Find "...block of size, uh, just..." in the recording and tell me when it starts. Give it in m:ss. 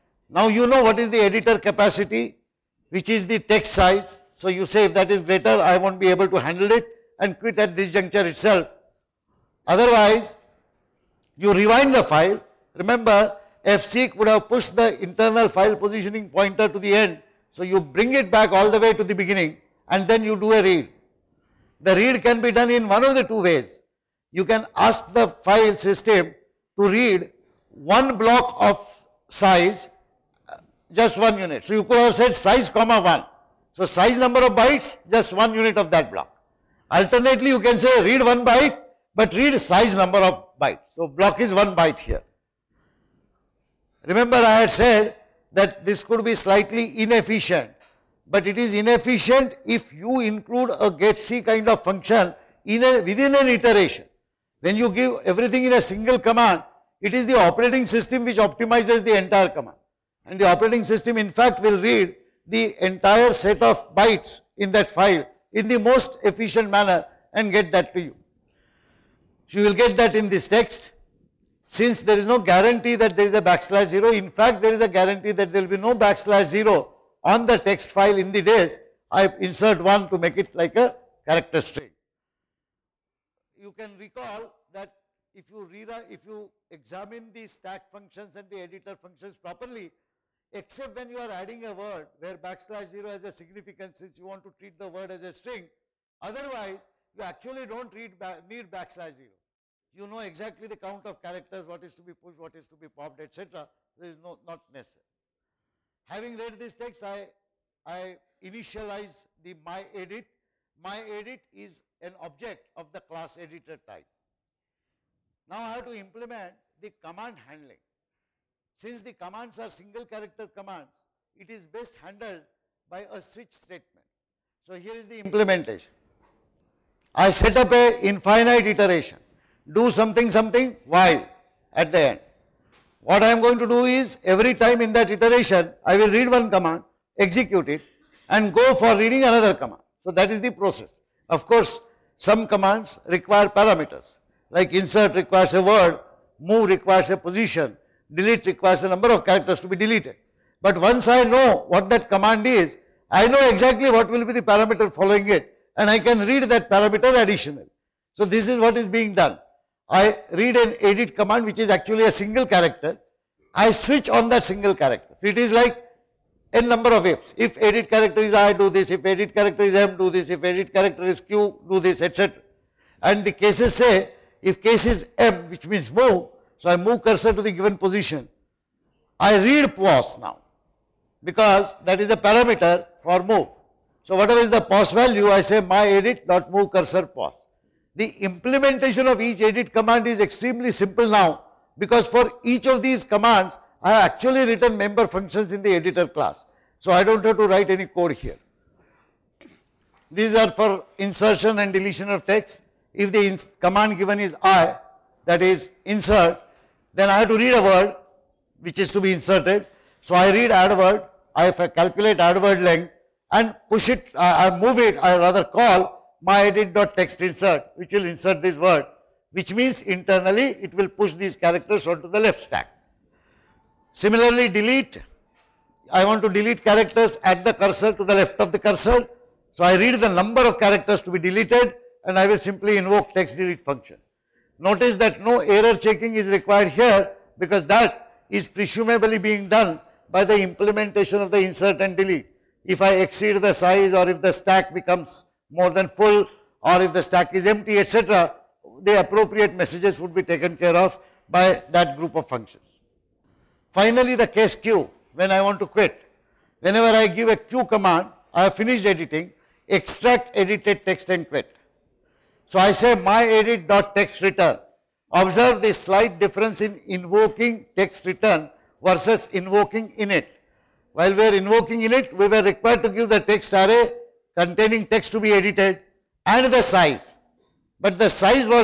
0:28.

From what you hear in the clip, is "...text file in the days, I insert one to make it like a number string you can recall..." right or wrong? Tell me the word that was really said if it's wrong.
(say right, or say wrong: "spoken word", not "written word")
wrong: "character", not "number".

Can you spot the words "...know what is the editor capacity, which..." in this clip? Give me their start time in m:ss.
0:00.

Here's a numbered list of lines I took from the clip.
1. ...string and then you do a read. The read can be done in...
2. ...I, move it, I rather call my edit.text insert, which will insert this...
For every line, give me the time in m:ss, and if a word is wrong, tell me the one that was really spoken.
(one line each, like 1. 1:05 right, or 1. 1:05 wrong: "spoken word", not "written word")
1. 0:19 wrong: "beginning", not "string"
2. 3:34 right.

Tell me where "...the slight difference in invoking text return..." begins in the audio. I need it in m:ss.
4:25.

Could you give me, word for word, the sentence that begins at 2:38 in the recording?
So this is what is being done.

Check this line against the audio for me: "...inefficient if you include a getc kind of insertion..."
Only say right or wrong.
wrong.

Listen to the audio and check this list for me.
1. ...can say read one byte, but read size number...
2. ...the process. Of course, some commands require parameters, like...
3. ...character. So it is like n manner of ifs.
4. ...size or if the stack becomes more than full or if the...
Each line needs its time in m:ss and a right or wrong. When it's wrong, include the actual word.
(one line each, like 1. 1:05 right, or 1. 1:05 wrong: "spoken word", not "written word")
1. 0:37 right
2. 2:20 right
3. 2:44 wrong: "number", not "manner"
4. 4:03 right.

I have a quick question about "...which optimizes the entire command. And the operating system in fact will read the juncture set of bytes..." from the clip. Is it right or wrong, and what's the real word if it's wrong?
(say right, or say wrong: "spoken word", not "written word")
wrong: "entire", not "juncture".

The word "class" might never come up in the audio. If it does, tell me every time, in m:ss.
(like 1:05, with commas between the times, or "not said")
1:53, 3:16.